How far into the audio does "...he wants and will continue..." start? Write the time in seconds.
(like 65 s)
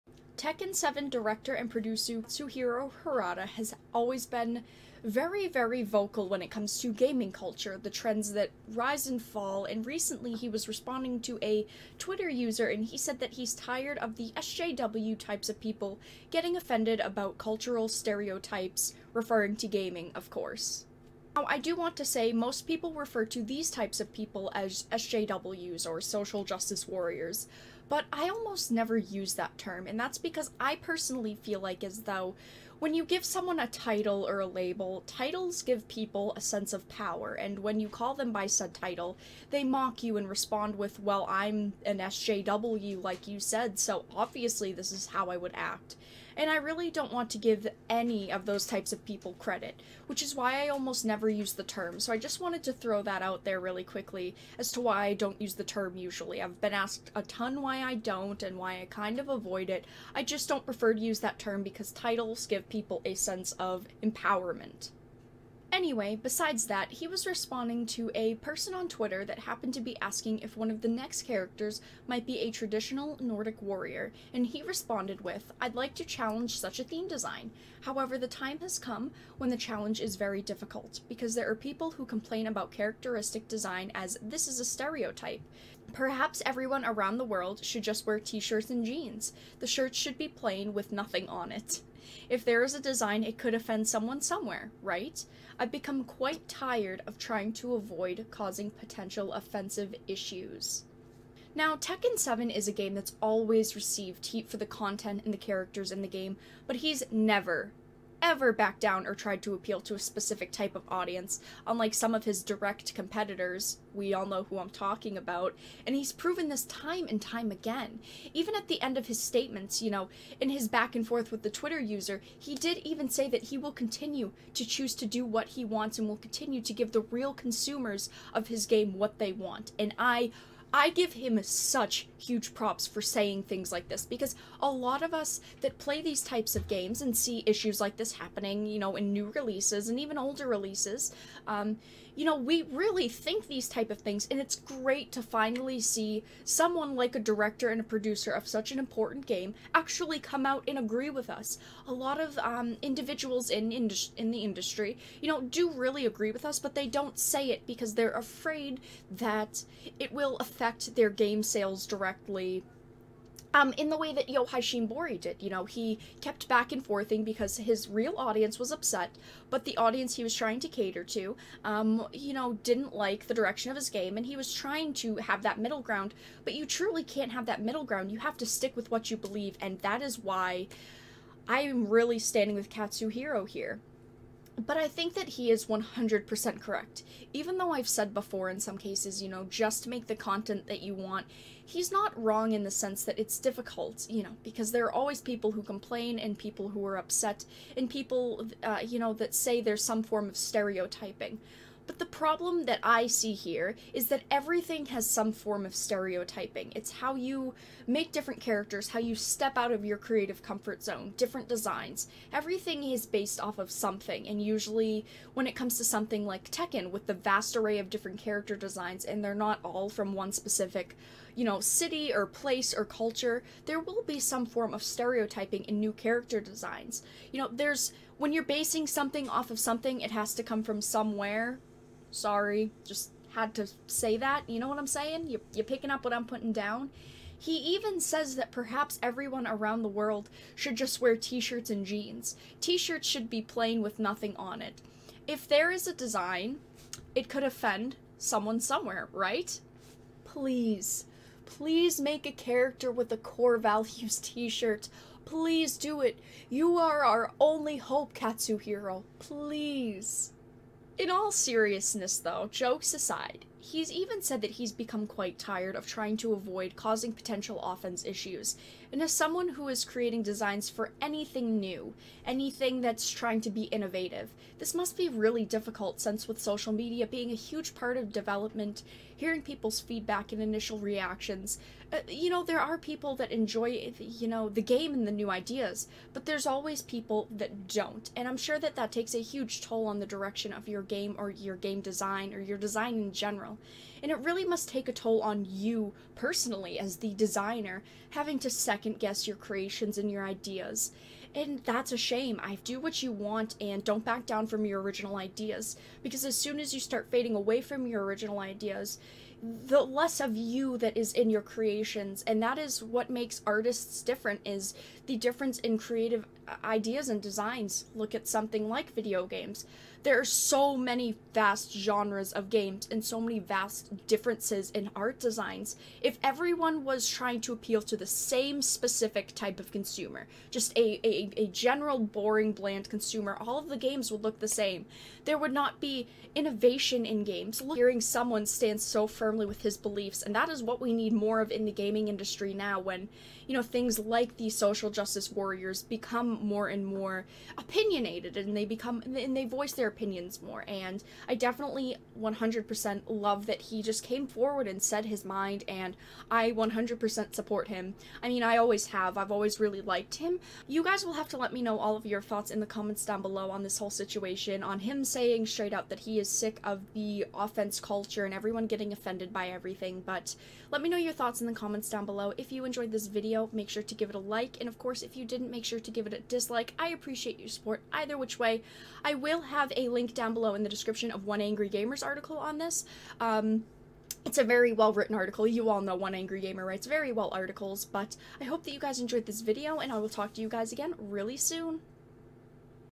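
125 s.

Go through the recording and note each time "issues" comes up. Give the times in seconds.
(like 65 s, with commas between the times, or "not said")
100 s, 137 s, 268 s.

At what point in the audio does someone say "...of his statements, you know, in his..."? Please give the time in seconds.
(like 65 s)
118 s.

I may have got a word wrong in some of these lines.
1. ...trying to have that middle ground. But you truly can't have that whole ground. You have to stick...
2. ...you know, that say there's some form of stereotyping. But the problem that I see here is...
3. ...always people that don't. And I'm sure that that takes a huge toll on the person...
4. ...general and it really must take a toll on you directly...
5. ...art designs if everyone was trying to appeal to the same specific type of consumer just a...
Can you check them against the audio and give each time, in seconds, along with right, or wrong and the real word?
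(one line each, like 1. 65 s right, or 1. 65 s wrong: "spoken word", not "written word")
1. 174 s wrong: "middle", not "whole"
2. 198 s right
3. 286 s wrong: "direction", not "person"
4. 293 s wrong: "personally", not "directly"
5. 324 s right.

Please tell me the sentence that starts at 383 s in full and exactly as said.
Um, it's a very well written article.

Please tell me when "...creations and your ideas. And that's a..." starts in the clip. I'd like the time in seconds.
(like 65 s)
299 s.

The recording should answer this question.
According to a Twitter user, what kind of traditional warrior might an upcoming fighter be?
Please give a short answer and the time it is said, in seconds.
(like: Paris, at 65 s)
Nordic, at 73 s.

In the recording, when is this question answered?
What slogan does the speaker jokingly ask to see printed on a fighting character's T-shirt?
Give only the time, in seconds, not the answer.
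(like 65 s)
253 s.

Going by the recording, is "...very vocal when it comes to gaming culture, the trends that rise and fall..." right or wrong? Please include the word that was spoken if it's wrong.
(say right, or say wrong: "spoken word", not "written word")
right.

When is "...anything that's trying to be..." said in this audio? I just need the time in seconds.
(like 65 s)
272 s.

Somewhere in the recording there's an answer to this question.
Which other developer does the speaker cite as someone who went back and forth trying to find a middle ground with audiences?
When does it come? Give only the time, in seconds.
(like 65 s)
164 s.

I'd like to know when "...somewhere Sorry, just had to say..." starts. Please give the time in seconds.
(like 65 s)
230 s.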